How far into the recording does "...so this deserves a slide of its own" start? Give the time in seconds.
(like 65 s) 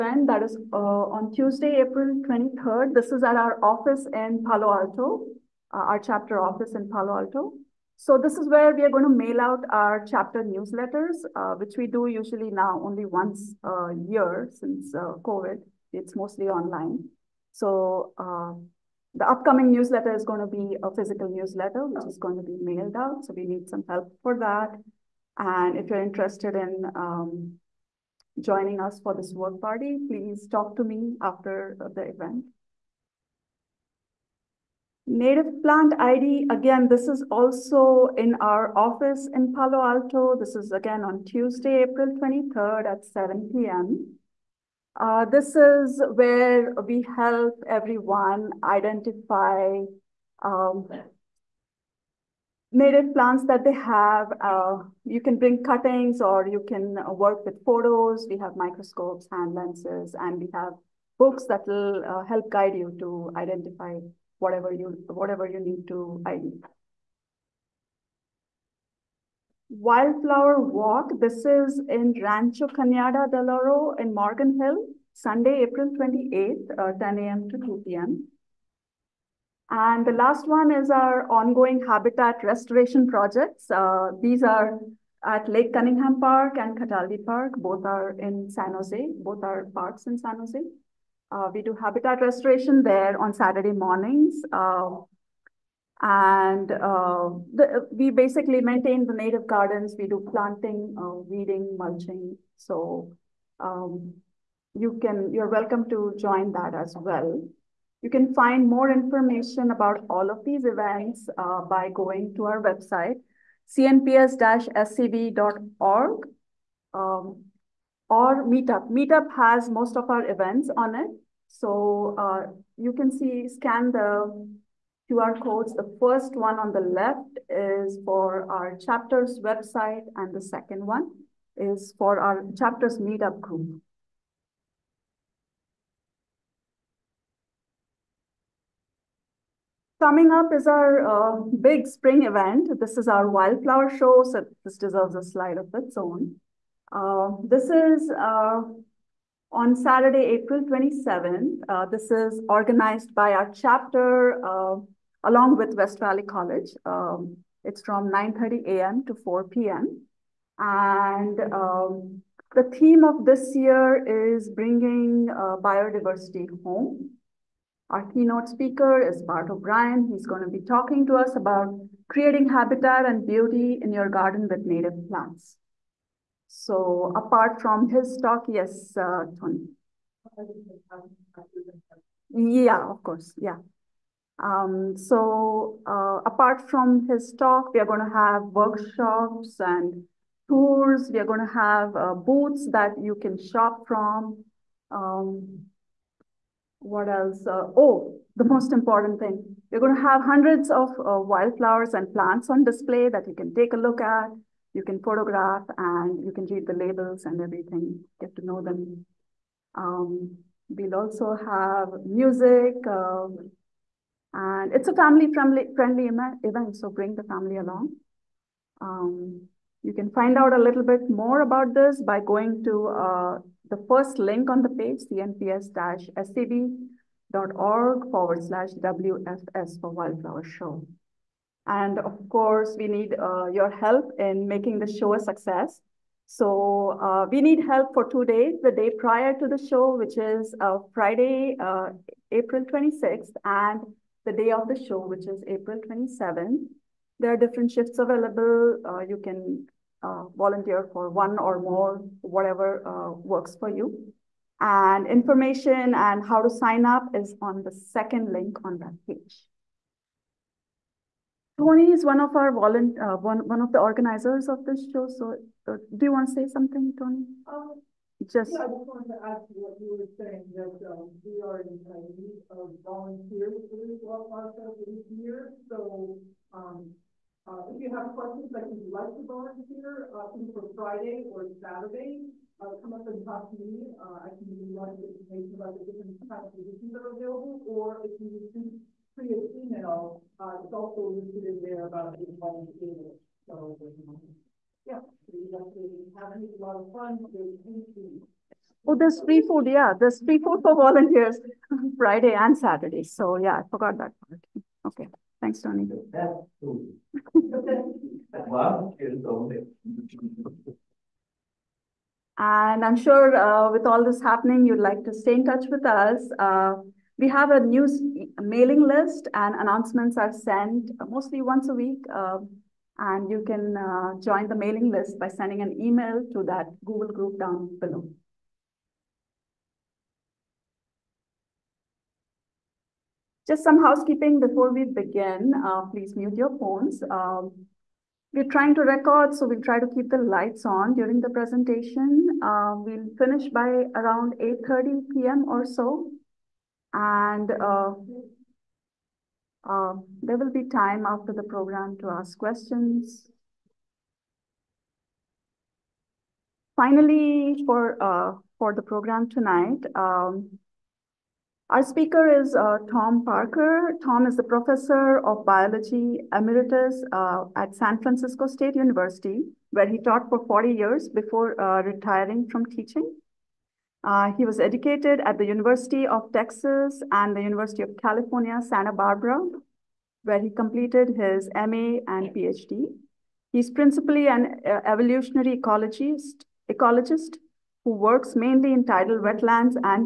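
144 s.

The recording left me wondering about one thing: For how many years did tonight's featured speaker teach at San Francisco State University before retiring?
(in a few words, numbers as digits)
40.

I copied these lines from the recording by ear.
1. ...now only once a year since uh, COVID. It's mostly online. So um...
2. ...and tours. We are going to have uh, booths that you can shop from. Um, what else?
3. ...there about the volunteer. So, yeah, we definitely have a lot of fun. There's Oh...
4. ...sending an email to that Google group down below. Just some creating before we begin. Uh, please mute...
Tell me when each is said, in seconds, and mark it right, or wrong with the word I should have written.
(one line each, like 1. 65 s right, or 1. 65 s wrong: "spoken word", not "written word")
1. 12 s right
2. 189 s right
3. 291 s right
4. 325 s wrong: "housekeeping", not "creating".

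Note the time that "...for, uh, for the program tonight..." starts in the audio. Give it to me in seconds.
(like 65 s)
357 s.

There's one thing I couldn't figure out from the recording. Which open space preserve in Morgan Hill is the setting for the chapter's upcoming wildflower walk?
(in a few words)
Rancho Cañada del Oro.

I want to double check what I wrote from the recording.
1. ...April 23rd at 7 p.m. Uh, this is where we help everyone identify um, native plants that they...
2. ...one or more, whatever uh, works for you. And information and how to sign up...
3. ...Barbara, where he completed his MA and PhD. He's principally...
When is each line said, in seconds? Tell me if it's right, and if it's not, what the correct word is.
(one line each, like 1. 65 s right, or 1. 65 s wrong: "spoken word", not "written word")
1. 41 s right
2. 251 s right
3. 378 s right.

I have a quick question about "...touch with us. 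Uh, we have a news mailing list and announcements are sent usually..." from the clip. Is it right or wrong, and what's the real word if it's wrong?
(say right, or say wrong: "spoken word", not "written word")
wrong: "mostly", not "usually".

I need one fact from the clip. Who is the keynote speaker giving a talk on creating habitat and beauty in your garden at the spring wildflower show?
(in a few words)
Bart O'Brien.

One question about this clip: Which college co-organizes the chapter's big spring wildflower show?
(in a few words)
West Valley College.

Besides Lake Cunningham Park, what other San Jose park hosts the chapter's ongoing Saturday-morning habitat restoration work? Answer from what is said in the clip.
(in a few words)
Cataldi Park.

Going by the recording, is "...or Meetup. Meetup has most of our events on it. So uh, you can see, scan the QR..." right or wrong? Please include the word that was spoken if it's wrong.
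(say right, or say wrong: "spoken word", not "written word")
right.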